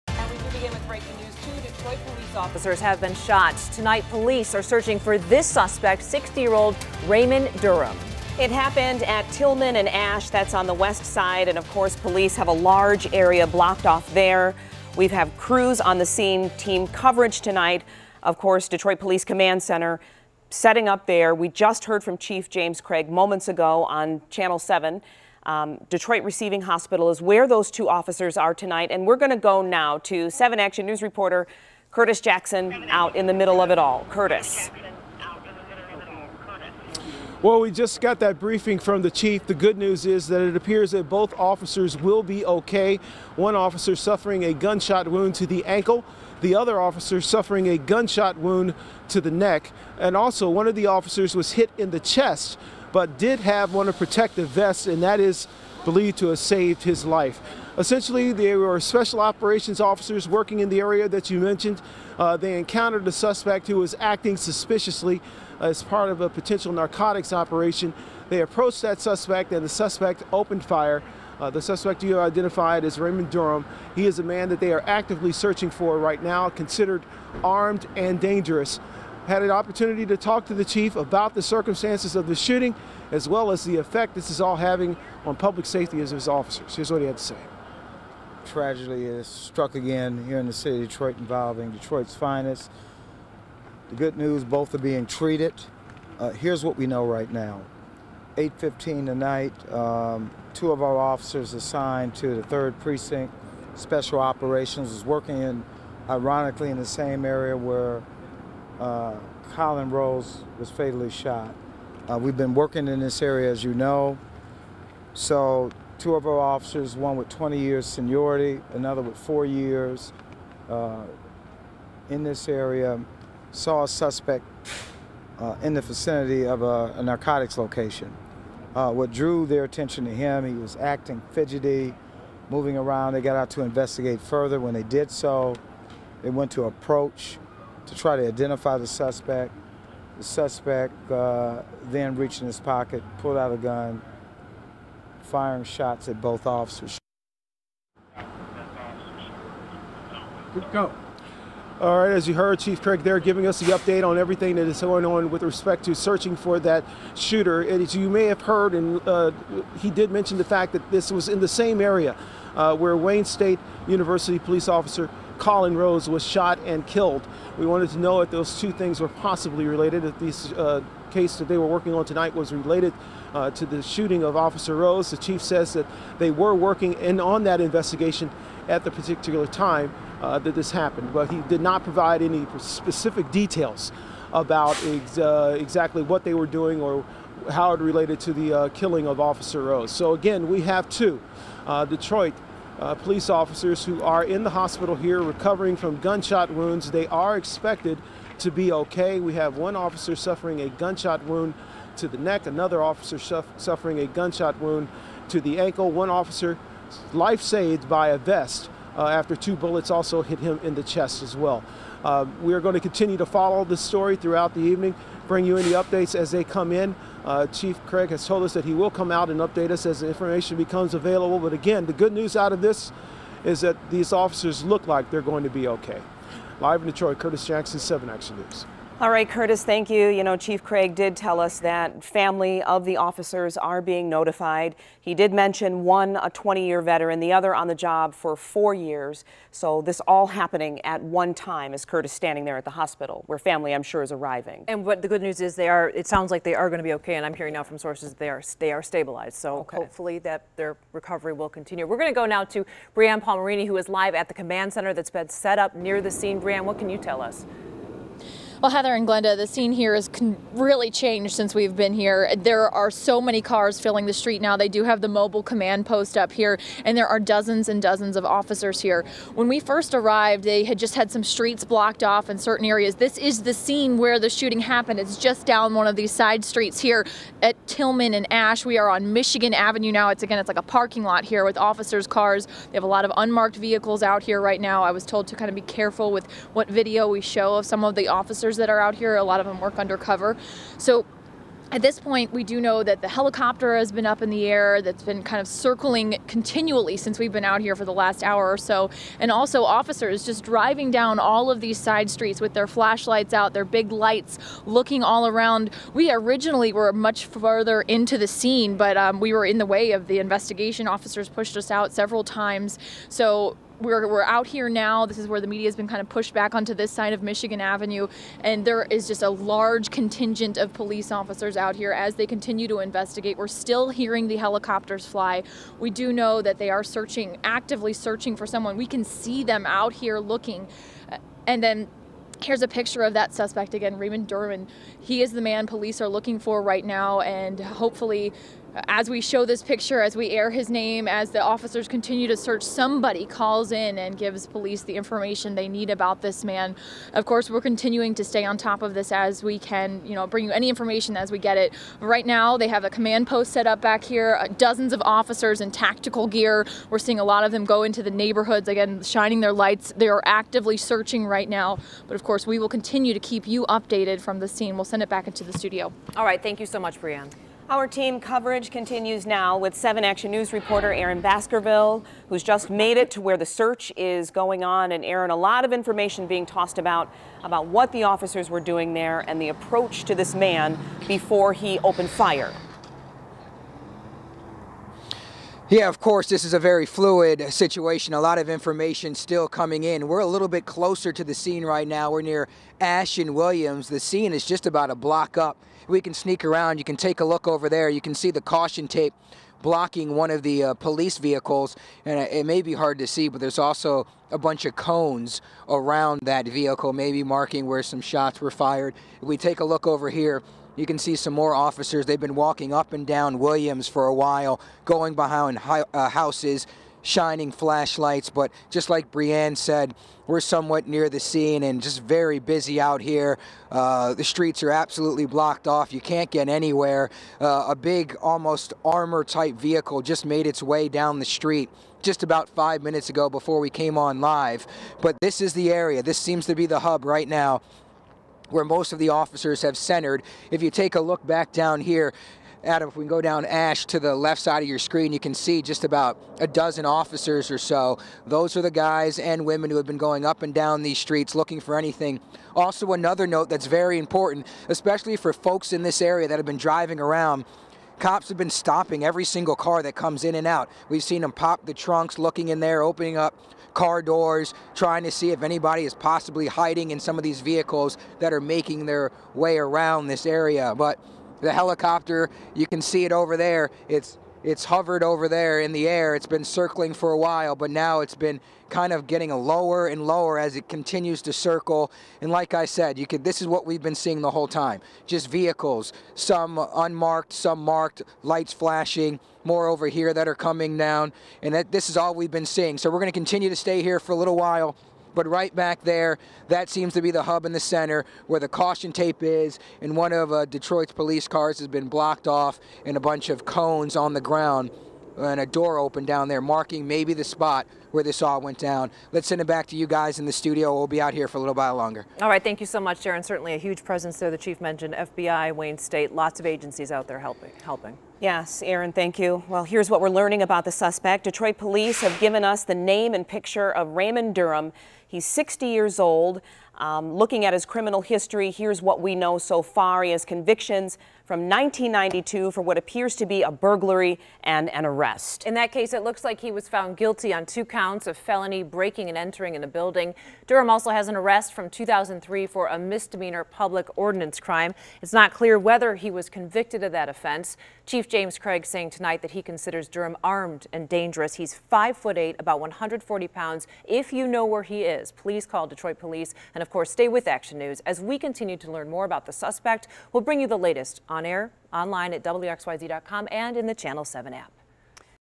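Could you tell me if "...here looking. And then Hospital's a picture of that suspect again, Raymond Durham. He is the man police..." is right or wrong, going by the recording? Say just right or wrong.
wrong.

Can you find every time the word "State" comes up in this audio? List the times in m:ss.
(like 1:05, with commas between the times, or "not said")
2:43, 8:35.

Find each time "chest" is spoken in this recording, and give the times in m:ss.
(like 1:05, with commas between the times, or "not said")
0:51, 3:30.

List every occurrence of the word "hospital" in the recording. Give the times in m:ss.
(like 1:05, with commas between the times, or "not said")
0:26, 3:14, 4:02.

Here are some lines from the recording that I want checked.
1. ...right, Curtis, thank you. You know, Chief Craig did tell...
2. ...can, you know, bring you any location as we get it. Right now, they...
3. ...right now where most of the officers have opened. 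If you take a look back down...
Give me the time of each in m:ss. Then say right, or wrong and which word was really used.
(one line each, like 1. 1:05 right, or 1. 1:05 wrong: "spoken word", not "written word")
1. 3:49 right
2. 5:49 wrong: "information", not "location"
3. 7:17 wrong: "centered", not "opened".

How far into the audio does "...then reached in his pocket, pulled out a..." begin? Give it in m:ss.
2:21.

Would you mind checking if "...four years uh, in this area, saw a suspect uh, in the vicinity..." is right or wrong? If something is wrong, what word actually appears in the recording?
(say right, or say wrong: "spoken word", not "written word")
right.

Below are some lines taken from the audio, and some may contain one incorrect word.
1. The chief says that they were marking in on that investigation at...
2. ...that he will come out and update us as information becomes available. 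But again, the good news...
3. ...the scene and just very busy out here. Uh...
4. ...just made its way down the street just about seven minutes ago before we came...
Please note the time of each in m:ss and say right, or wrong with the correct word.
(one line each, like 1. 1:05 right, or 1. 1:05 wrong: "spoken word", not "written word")
1. 2:55 wrong: "working", not "marking"
2. 3:38 right
3. 7:01 right
4. 7:10 wrong: "five", not "seven".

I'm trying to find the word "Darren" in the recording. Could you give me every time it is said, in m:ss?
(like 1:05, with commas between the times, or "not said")
8:32.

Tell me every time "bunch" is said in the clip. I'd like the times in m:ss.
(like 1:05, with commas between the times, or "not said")
6:44, 8:22.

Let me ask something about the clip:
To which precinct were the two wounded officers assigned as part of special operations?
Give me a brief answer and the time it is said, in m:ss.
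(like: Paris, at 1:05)
3rd Precinct, at 1:42.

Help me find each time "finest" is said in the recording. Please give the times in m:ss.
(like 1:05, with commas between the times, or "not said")
1:32.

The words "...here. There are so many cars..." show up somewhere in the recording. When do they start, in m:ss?
4:21.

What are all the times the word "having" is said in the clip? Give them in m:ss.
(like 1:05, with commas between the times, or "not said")
1:24.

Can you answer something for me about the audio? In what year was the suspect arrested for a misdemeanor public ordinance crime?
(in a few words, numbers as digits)
2003.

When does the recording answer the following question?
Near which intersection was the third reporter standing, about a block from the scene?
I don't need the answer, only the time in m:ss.
6:32.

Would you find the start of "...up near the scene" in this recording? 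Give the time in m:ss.
4:15.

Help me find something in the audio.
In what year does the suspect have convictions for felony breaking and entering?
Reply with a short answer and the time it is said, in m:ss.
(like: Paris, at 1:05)
1992, at 8:51.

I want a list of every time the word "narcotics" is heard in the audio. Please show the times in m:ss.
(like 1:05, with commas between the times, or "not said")
1:06, 2:07.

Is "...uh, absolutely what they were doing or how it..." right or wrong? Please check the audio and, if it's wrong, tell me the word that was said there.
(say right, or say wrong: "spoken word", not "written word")
wrong: "exactly", not "absolutely".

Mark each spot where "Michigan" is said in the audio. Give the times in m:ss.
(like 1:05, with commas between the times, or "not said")
4:39, 5:17.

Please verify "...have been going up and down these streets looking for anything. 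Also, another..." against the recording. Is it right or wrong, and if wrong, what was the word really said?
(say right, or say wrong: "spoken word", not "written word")
right.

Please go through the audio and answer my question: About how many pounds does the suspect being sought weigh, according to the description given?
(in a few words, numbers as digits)
140.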